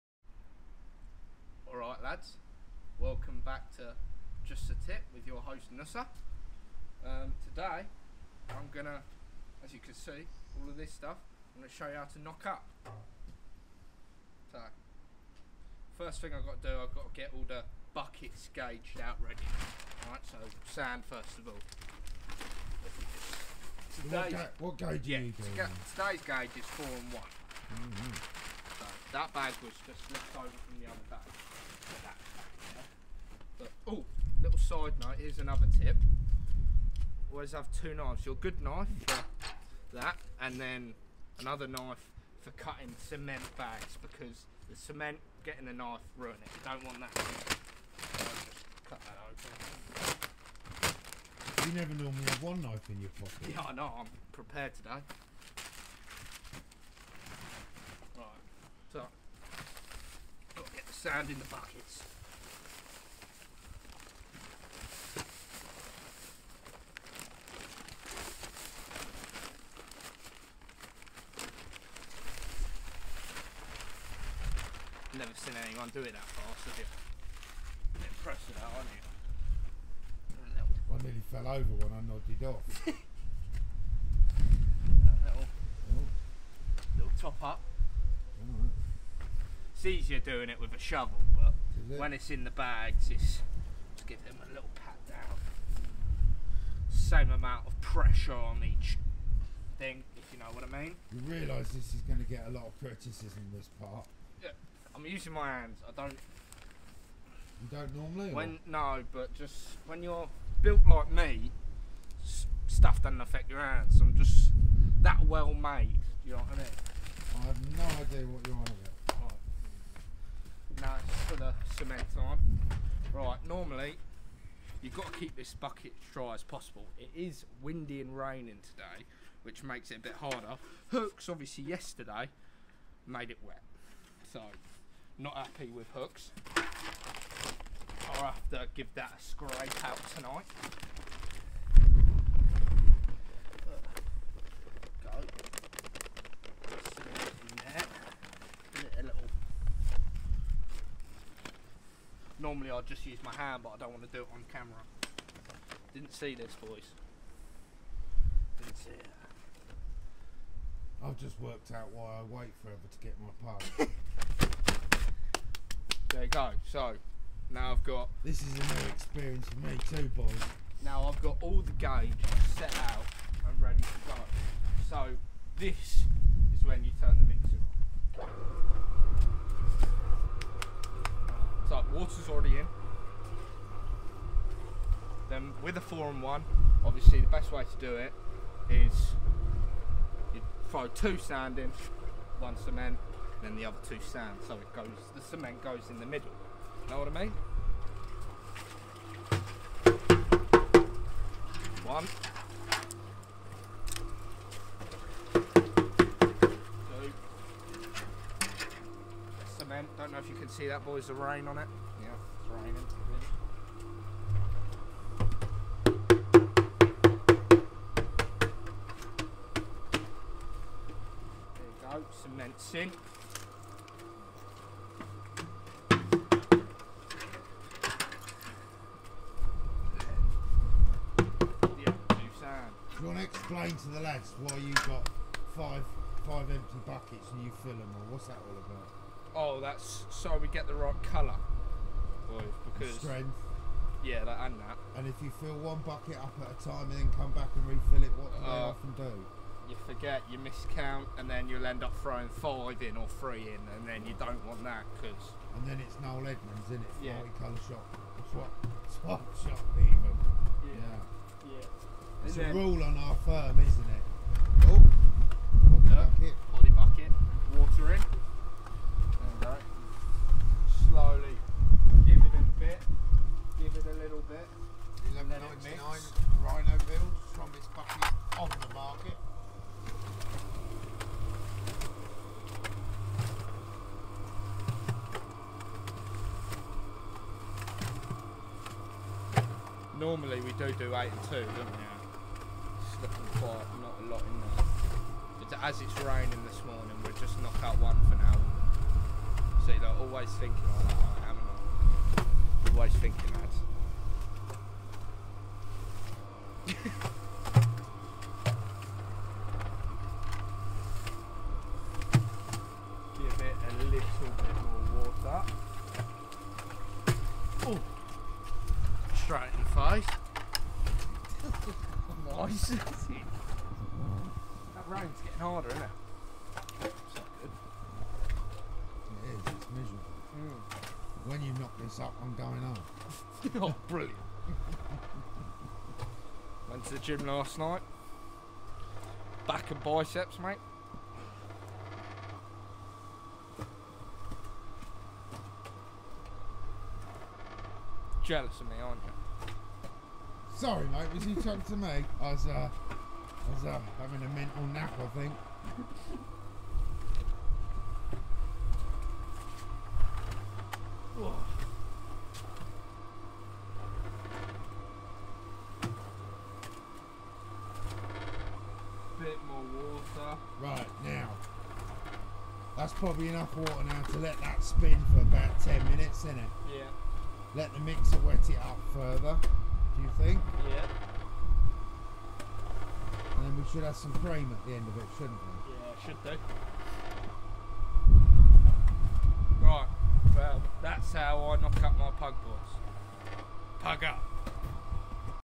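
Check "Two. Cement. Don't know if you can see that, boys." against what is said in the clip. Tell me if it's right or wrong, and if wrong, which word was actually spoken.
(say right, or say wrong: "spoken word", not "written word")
right.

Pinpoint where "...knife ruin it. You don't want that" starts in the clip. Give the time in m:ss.
0:45.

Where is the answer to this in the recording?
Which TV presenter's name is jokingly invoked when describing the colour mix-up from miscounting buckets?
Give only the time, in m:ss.
4:16.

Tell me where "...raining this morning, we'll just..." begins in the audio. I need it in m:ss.
4:56.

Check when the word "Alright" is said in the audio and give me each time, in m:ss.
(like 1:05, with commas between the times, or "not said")
0:01, 0:20.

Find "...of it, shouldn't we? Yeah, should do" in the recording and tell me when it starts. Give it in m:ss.
6:24.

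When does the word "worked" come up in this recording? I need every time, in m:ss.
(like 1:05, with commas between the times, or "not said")
2:41.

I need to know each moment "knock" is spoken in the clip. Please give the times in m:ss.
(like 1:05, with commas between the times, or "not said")
0:12, 4:57, 5:31, 6:31.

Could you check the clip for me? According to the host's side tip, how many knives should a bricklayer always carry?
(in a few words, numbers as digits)
2.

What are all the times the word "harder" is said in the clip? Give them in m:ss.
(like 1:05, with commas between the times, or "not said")
2:10, 5:25.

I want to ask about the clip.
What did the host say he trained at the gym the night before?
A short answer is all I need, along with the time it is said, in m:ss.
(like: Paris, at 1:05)
Back and biceps, at 5:39.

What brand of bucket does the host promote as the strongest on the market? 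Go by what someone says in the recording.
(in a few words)
Rhino.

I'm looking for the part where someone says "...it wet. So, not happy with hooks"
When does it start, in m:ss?
2:13.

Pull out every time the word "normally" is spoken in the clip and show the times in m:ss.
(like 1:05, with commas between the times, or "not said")
0:52, 1:47, 2:03, 2:32, 4:49.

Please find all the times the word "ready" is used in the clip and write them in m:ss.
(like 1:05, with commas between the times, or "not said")
0:19, 2:53.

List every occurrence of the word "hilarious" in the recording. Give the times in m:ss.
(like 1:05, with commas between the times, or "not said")
not said.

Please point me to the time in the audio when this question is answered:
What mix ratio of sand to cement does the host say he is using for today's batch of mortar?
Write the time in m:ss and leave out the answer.
0:26.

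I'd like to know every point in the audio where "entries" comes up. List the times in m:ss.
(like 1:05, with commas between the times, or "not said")
not said.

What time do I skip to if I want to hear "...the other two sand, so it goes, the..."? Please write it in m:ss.
3:13.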